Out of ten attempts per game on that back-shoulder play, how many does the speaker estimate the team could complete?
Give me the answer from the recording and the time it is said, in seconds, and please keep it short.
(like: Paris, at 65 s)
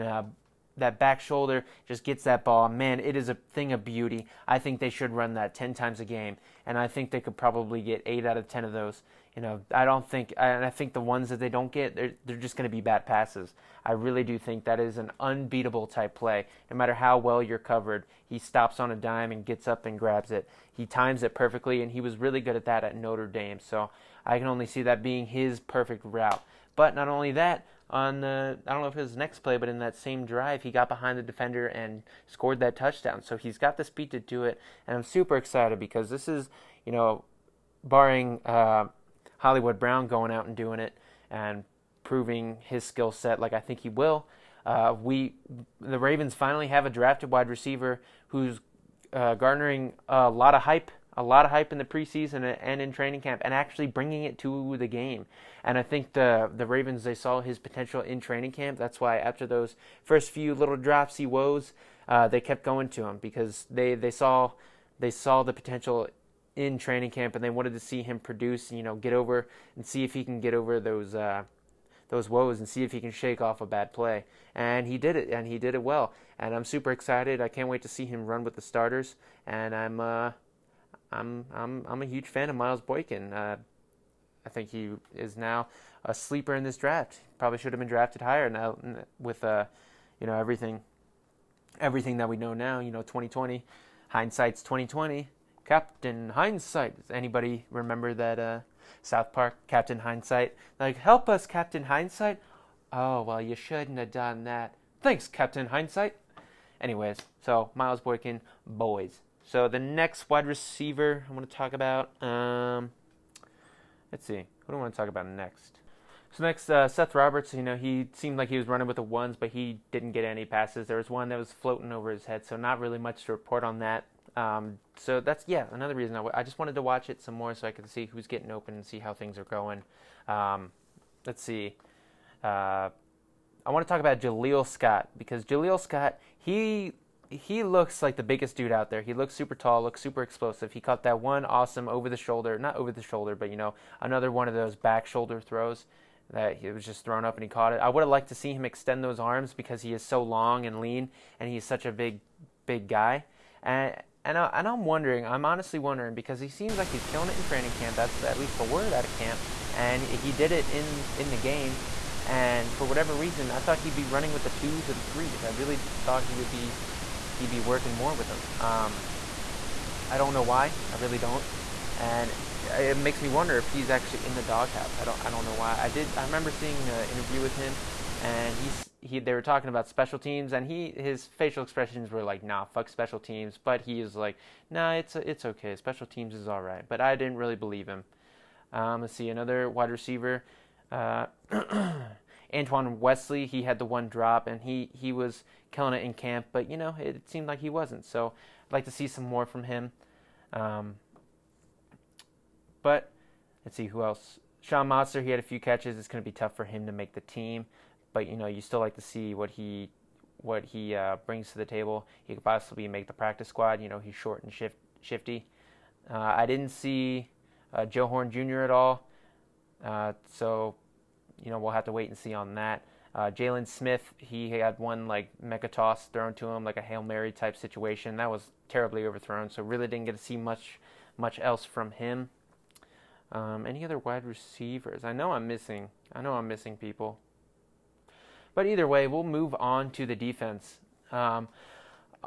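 8, at 8 s.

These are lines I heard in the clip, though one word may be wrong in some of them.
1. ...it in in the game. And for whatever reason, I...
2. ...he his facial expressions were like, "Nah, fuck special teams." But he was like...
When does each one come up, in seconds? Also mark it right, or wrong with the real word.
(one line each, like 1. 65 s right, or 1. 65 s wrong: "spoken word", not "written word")
1. 160 s right
2. 180 s right.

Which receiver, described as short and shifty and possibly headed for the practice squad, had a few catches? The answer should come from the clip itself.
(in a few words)
Sean Modster.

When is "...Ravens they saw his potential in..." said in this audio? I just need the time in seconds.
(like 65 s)
56 s.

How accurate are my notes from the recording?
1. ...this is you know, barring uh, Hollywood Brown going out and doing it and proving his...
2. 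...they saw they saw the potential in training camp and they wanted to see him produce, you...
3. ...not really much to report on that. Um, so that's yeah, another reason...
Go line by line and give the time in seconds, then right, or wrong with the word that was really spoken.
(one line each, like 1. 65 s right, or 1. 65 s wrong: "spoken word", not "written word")
1. 36 s right
2. 63 s right
3. 122 s right.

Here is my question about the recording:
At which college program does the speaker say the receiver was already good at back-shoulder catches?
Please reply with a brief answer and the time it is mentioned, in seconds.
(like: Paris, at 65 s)
Notre Dame, at 22 s.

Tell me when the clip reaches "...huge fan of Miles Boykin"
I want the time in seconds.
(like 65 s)
82 s.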